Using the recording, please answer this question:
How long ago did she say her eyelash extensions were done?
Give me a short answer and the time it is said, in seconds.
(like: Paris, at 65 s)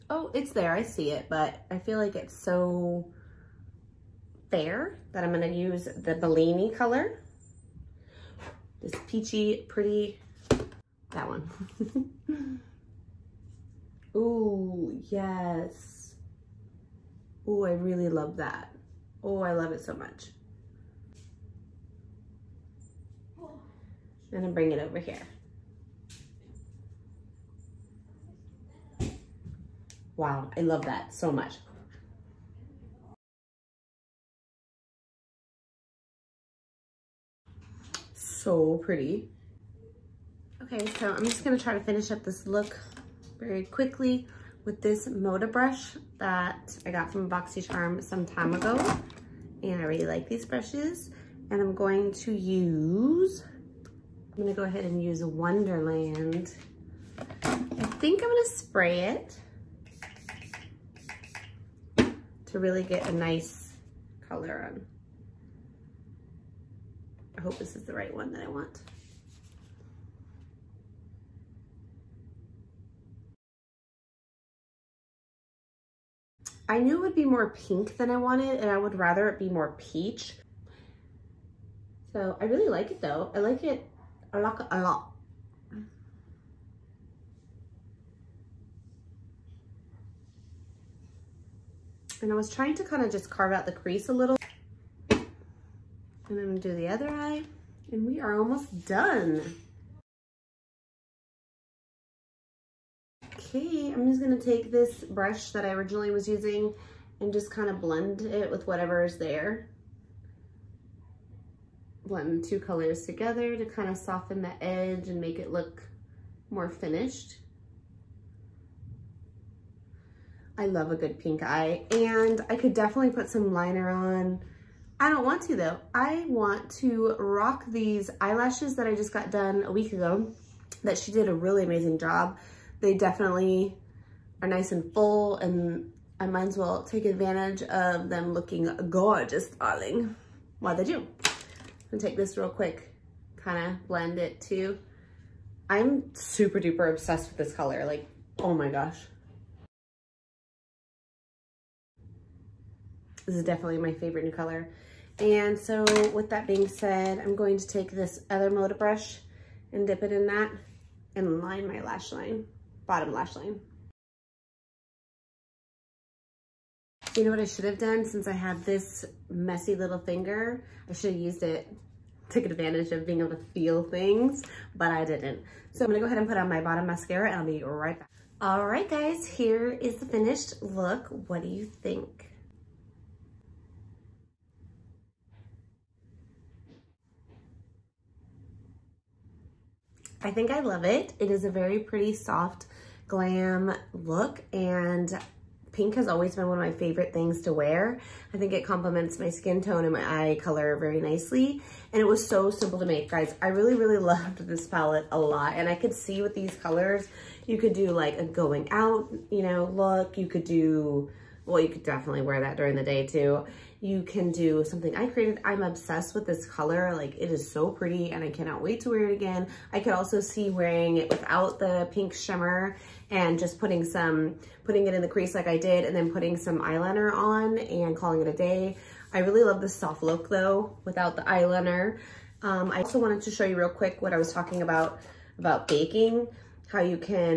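a week ago, at 129 s.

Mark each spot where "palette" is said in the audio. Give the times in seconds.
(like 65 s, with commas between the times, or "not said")
204 s.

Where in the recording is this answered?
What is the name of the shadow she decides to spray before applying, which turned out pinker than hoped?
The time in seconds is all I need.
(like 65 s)
55 s.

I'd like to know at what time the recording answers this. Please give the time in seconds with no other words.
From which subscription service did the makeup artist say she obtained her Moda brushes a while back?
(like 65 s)
47 s.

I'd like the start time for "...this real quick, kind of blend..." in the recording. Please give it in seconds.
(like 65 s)
142 s.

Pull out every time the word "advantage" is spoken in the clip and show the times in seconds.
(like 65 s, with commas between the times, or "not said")
137 s, 172 s.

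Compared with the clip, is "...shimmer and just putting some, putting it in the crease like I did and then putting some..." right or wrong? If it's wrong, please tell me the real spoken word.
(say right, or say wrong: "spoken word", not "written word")
right.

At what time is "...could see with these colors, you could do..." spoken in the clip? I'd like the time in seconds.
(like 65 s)
205 s.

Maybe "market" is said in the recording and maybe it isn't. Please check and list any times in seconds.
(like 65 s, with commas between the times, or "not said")
not said.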